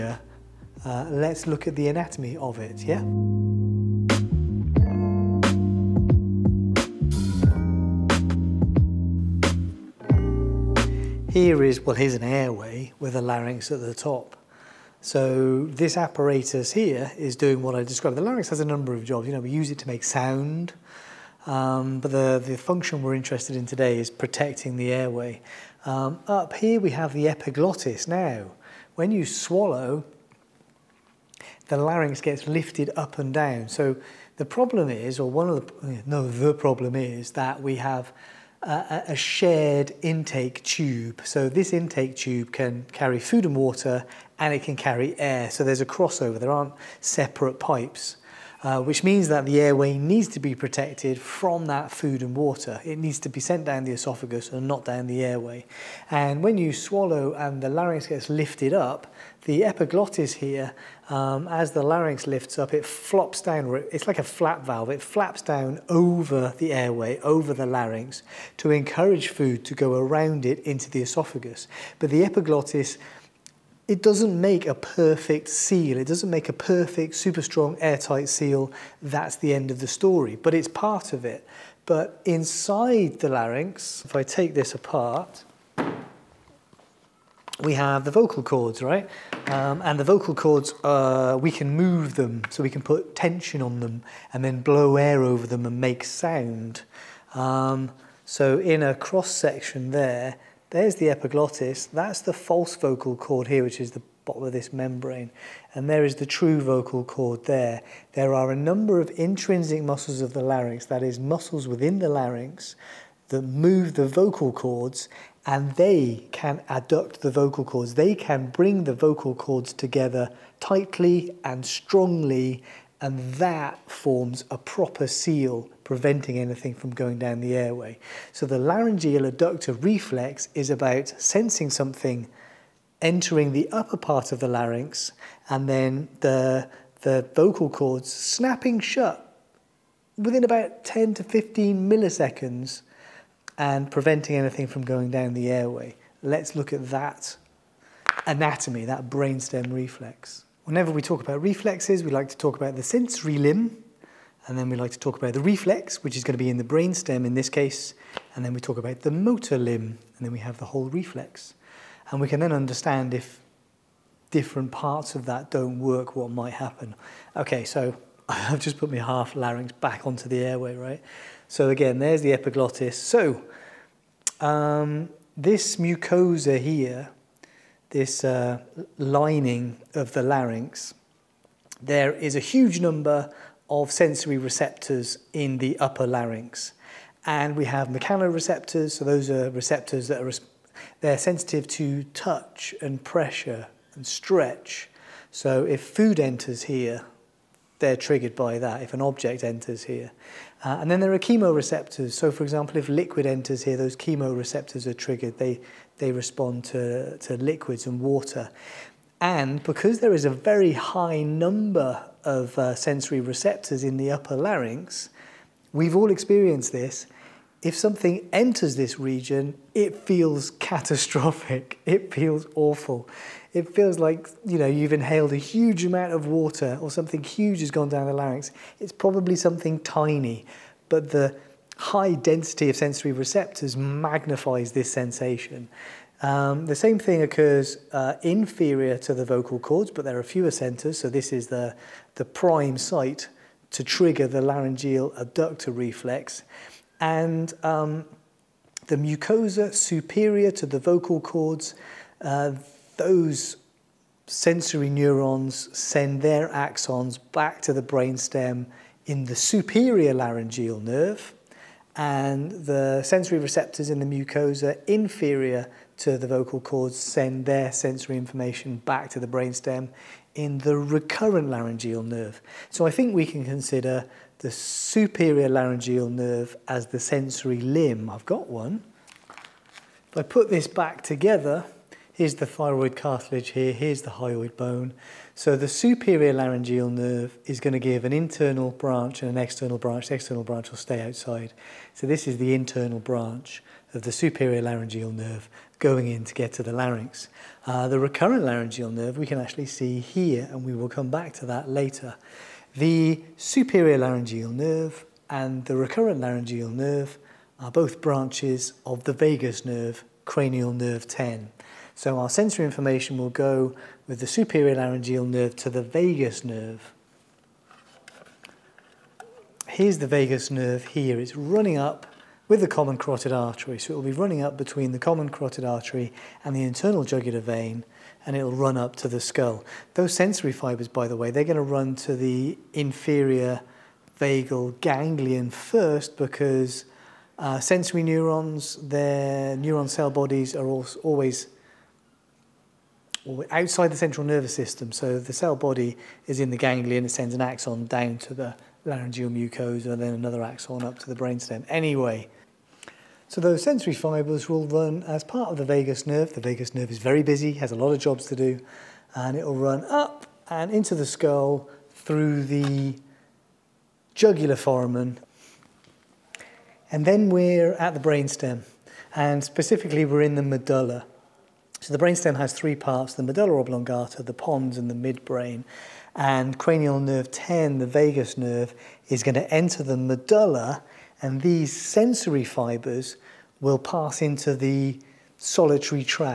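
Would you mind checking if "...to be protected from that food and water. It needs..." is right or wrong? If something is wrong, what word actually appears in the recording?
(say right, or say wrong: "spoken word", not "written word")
right.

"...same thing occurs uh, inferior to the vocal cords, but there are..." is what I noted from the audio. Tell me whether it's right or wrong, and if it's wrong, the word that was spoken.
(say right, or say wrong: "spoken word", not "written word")
right.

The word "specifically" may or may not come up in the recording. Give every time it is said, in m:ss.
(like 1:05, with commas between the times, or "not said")
6:09.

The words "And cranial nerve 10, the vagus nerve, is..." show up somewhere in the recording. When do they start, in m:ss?
6:16.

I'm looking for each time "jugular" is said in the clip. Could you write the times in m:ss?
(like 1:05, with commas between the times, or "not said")
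5:27, 6:04.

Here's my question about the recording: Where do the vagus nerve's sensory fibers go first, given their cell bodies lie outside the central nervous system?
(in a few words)
inferior vagal ganglion.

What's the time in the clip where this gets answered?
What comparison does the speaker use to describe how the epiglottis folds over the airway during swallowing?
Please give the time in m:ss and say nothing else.
1:04.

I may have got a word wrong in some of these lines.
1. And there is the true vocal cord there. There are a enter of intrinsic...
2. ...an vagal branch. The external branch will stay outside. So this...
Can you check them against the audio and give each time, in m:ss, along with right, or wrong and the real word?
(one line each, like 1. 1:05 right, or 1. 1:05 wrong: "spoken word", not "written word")
1. 1:45 wrong: "number", not "enter"
2. 4:49 wrong: "external", not "vagal".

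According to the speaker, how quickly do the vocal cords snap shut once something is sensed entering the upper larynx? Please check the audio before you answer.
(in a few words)
10 to 15 milliseconds.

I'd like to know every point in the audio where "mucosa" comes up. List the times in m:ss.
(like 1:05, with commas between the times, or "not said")
2:55, 4:08, 4:24, 5:49.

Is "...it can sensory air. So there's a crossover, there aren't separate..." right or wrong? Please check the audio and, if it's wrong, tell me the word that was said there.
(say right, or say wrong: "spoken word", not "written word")
wrong: "carry", not "sensory".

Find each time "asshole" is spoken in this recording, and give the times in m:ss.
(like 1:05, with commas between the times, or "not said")
not said.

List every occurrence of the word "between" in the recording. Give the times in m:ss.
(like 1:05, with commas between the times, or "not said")
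5:24.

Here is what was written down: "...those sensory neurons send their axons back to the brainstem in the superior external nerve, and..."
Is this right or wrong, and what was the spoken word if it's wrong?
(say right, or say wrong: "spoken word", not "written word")
wrong: "laryngeal", not "external".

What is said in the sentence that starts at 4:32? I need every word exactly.
So I think we can consider the superior laryngeal nerve as the sensory limb.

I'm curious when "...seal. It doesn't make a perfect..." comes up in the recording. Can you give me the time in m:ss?
1:15.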